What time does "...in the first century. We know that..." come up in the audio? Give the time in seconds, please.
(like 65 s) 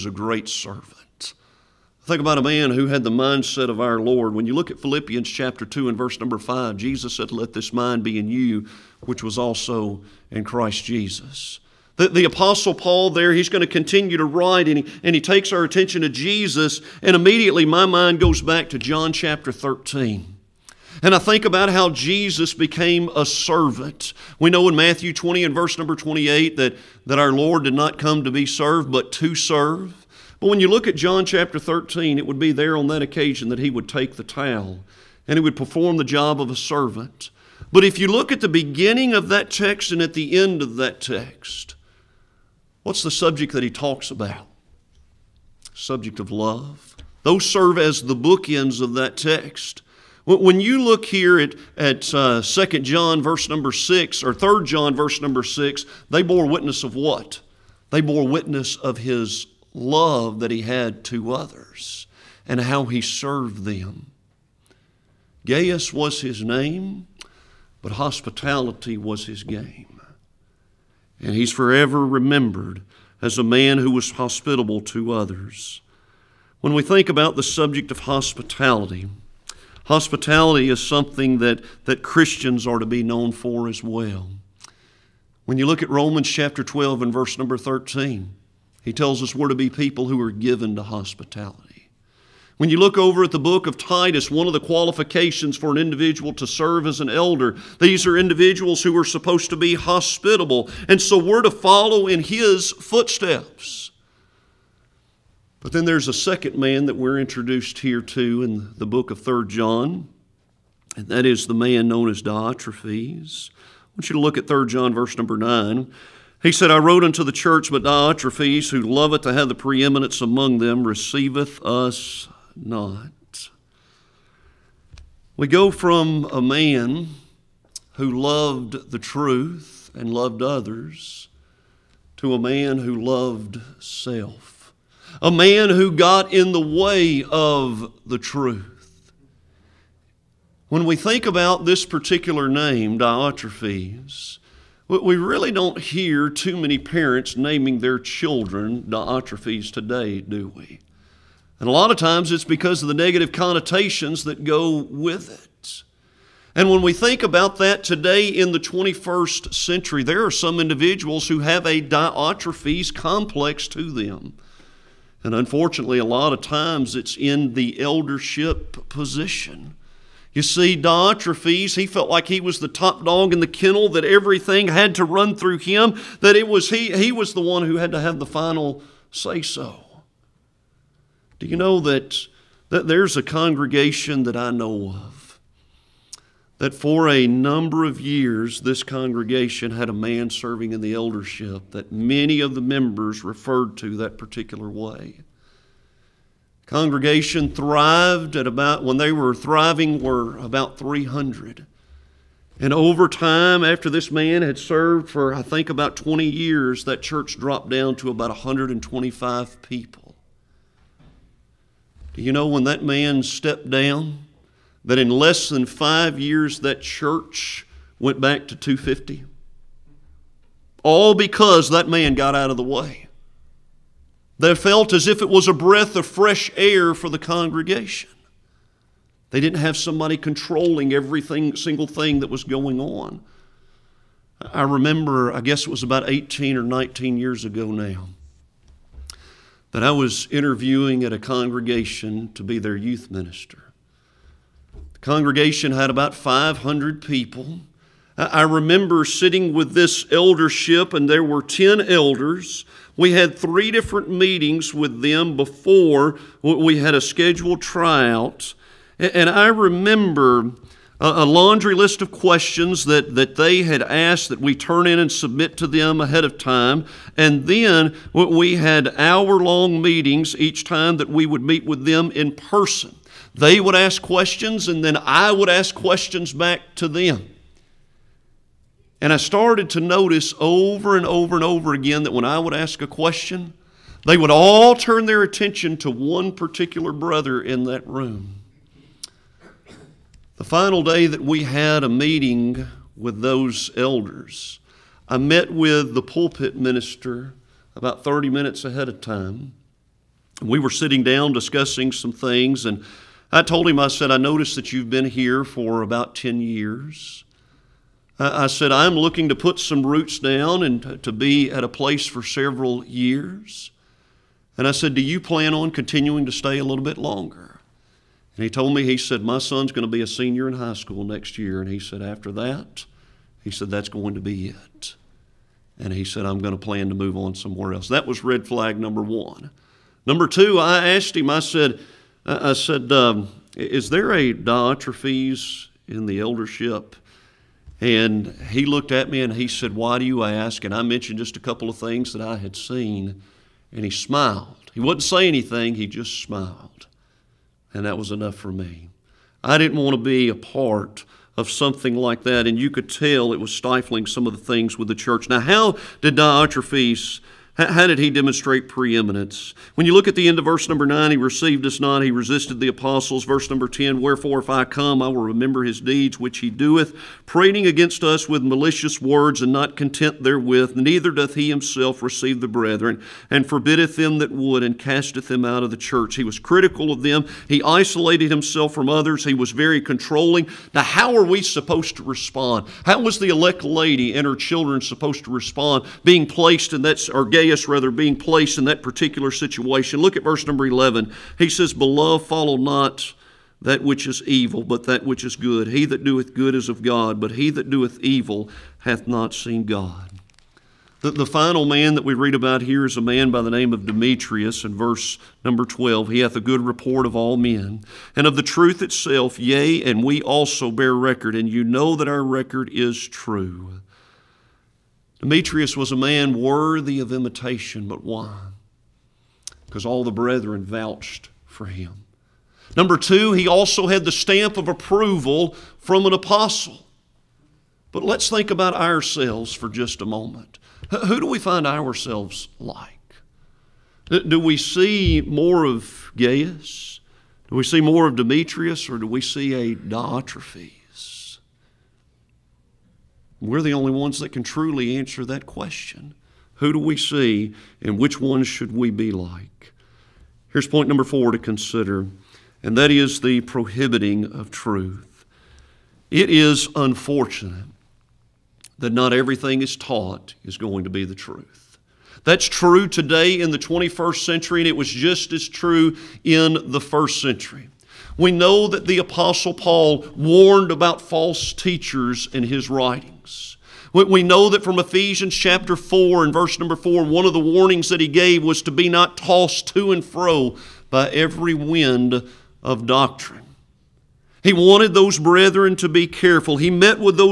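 466 s.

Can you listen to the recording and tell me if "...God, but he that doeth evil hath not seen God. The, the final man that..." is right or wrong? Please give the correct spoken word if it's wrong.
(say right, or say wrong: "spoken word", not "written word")
right.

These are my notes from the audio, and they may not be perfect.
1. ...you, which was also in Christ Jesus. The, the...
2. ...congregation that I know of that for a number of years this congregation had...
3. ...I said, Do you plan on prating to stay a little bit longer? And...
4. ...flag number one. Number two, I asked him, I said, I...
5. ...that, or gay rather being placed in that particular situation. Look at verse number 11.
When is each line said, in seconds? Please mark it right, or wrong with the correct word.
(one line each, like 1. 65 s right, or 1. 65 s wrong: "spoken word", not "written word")
1. 8 s right
2. 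183 s right
3. 314 s wrong: "continuing", not "prating"
4. 328 s right
5. 386 s right.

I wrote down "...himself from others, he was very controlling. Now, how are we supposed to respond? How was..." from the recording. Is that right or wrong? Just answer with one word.
right.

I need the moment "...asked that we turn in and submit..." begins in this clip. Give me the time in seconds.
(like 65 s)
263 s.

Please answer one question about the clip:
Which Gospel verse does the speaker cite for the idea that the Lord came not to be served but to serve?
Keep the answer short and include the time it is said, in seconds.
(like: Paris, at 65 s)
Matthew 20:28, at 24 s.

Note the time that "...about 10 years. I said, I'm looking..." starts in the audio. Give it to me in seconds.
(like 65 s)
305 s.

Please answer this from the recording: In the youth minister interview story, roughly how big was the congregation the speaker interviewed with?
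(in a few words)
500 people.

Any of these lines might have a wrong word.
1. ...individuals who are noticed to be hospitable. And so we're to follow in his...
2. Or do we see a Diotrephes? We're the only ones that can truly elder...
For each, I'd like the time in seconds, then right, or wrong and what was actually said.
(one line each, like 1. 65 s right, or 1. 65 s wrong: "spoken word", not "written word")
1. 98 s wrong: "supposed", not "noticed"
2. 438 s wrong: "answer", not "elder".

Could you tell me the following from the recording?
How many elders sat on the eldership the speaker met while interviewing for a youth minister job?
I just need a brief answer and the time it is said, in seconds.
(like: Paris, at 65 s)
10, at 251 s.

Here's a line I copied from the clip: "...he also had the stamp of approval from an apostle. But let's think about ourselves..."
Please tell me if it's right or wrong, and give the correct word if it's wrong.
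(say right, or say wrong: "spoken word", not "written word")
right.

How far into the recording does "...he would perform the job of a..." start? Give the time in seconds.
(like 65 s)
35 s.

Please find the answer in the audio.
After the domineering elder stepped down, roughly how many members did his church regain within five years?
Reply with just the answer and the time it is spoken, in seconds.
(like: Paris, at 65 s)
250, at 218 s.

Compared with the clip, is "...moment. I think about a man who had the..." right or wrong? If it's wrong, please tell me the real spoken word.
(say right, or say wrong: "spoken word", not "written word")
wrong: "servant", not "moment".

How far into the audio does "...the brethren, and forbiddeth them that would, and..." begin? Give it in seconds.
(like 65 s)
372 s.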